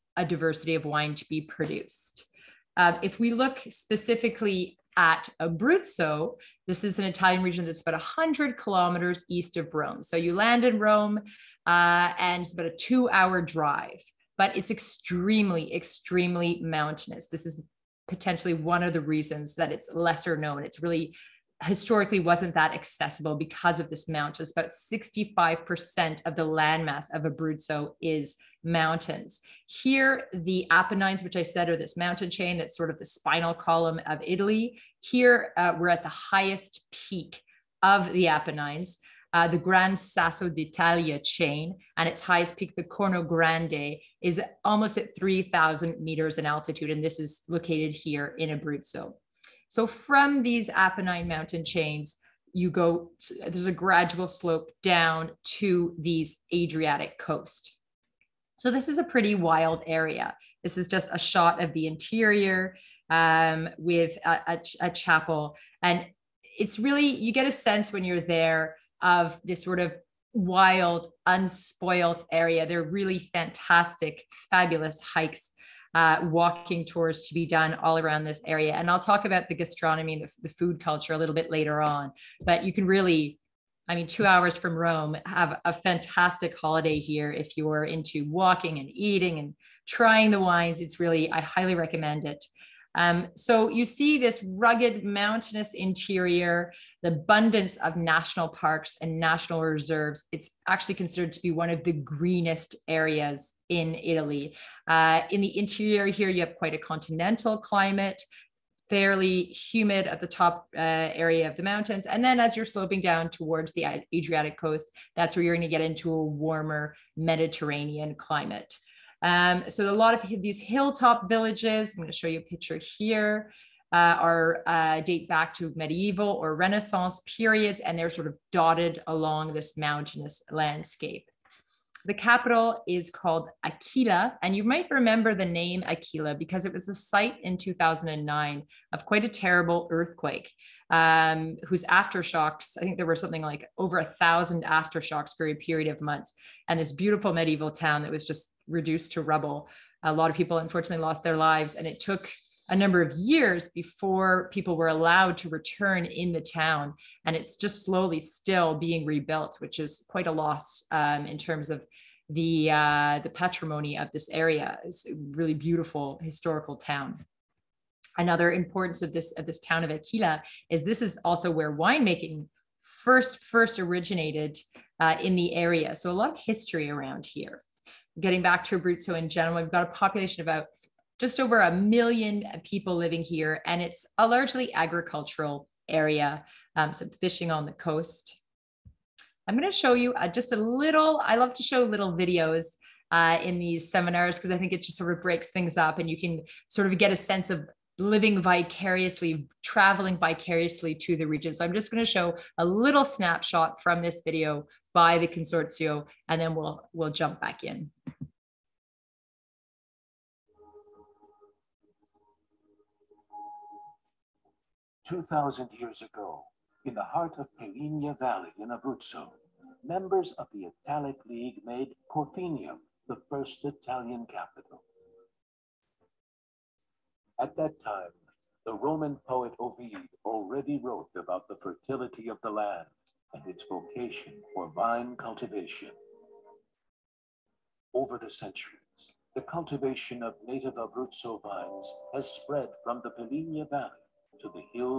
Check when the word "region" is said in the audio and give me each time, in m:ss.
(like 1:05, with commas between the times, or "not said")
0:07, 3:21.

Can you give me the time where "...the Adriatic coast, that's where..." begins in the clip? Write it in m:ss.
1:53.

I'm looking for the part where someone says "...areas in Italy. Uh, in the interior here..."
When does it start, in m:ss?
1:42.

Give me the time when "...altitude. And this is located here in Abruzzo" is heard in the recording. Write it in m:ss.
0:46.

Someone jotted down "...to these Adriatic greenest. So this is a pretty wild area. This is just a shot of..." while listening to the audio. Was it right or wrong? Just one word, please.
wrong.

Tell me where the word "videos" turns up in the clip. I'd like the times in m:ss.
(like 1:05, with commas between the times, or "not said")
3:12, 3:24.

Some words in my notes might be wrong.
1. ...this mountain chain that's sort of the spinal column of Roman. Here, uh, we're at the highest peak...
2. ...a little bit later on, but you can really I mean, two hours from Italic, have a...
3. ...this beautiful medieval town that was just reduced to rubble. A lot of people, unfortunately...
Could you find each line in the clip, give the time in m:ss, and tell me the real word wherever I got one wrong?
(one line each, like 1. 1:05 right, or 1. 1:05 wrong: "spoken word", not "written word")
1. 0:31 wrong: "Italy", not "Roman"
2. 1:21 wrong: "Rome", not "Italic"
3. 2:26 right.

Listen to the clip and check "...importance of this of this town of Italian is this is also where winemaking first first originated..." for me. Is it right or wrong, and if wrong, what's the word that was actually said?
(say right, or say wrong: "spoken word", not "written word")
wrong: "Aquila", not "Italian".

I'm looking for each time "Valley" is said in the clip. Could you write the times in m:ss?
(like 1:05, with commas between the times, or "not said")
3:38, 4:03.